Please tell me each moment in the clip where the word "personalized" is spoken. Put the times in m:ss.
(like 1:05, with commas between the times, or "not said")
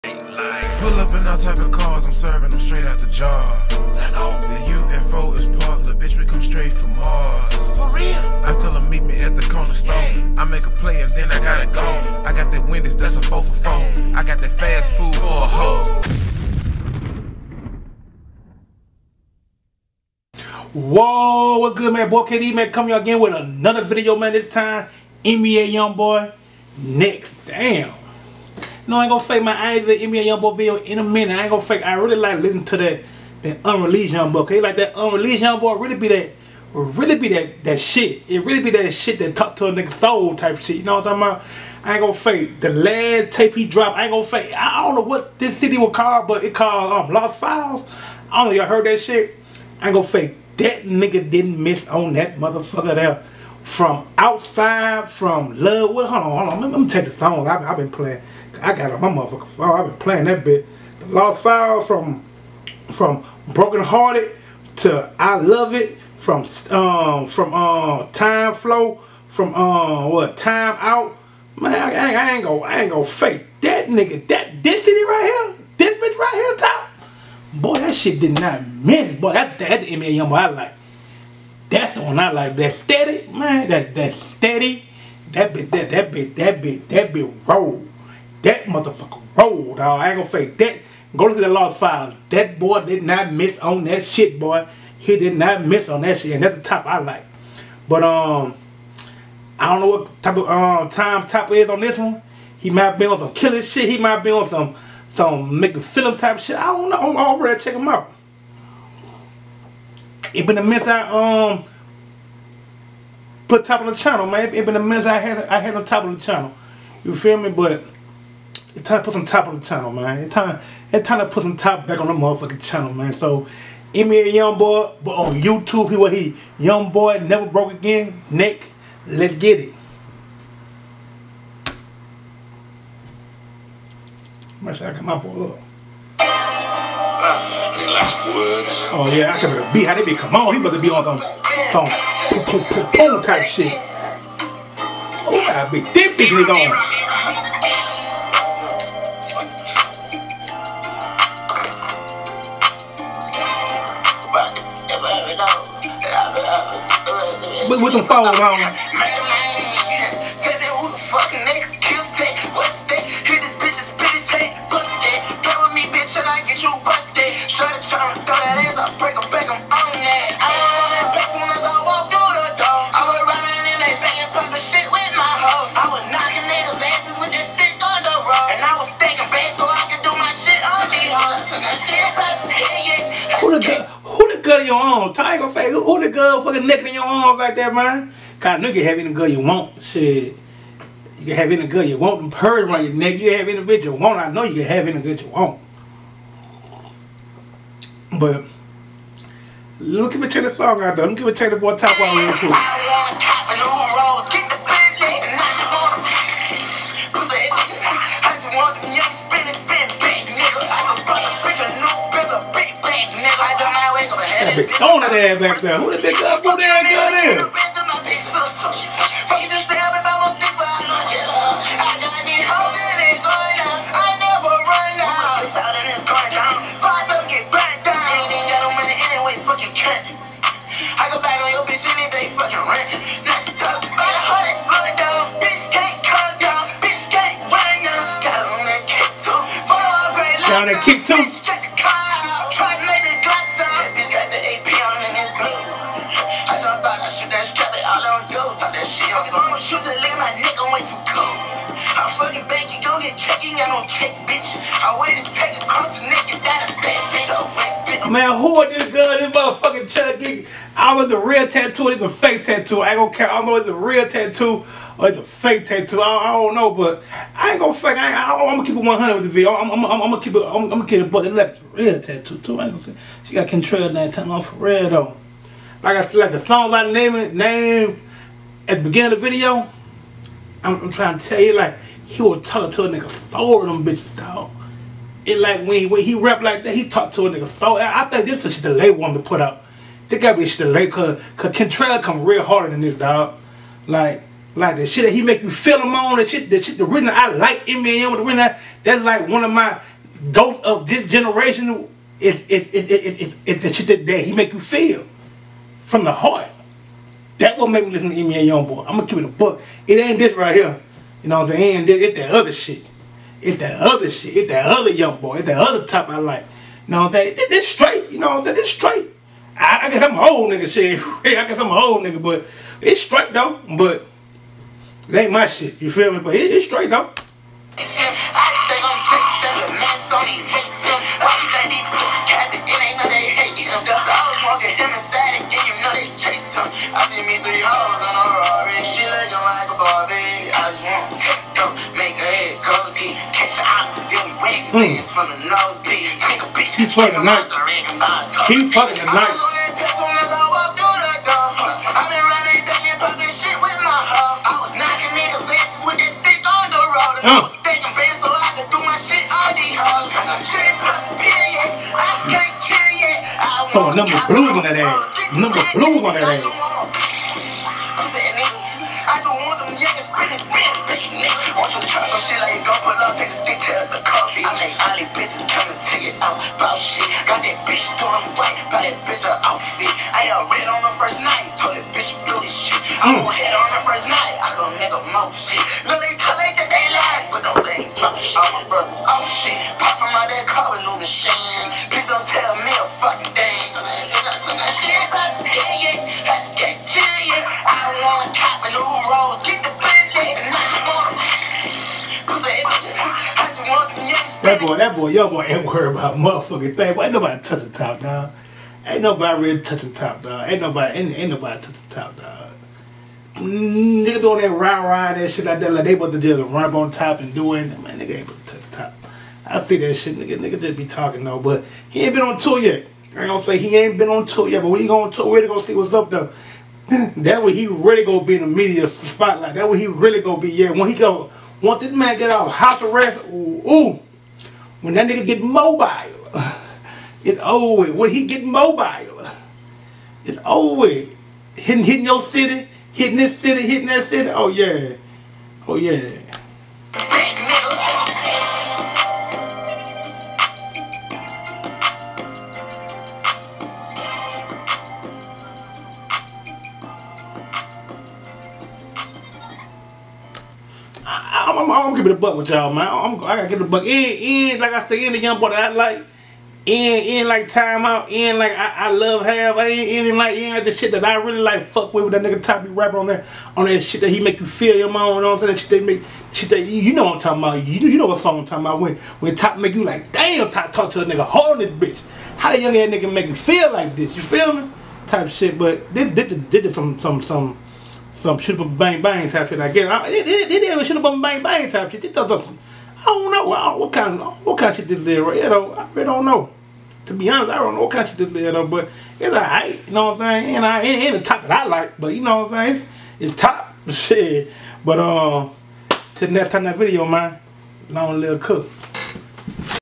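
not said.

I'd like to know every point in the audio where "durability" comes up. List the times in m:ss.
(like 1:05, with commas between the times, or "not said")
not said.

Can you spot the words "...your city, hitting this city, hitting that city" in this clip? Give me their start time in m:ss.
7:22.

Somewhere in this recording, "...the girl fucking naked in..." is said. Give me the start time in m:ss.
3:06.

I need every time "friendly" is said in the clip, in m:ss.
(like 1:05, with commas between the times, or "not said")
not said.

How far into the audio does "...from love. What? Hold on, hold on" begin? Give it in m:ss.
0:55.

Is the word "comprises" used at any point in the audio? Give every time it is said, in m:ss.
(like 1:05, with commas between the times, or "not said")
not said.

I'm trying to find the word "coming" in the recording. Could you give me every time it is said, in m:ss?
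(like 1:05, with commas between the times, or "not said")
0:22.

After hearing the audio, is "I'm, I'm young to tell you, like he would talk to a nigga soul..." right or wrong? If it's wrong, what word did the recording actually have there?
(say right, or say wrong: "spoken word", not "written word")
wrong: "trying", not "young".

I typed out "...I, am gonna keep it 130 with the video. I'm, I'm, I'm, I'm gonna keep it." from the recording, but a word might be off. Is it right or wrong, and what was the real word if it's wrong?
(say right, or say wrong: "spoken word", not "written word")
wrong: "100", not "130".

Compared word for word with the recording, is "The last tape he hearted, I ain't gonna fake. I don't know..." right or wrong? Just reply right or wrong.
wrong.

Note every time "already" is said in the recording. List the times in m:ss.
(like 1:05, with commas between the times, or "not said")
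1:47.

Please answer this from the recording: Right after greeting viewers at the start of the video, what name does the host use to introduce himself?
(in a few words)
KD.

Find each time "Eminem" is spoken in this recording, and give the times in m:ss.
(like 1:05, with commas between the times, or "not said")
4:57, 5:08.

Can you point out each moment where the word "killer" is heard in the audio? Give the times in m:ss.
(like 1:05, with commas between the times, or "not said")
1:43.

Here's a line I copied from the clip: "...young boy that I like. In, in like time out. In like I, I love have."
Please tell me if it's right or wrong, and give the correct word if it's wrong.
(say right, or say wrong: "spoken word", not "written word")
right.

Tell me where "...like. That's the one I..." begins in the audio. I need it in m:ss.
1:20.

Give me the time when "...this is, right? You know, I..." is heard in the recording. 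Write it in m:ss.
8:14.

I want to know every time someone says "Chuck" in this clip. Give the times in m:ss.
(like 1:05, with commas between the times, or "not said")
4:19.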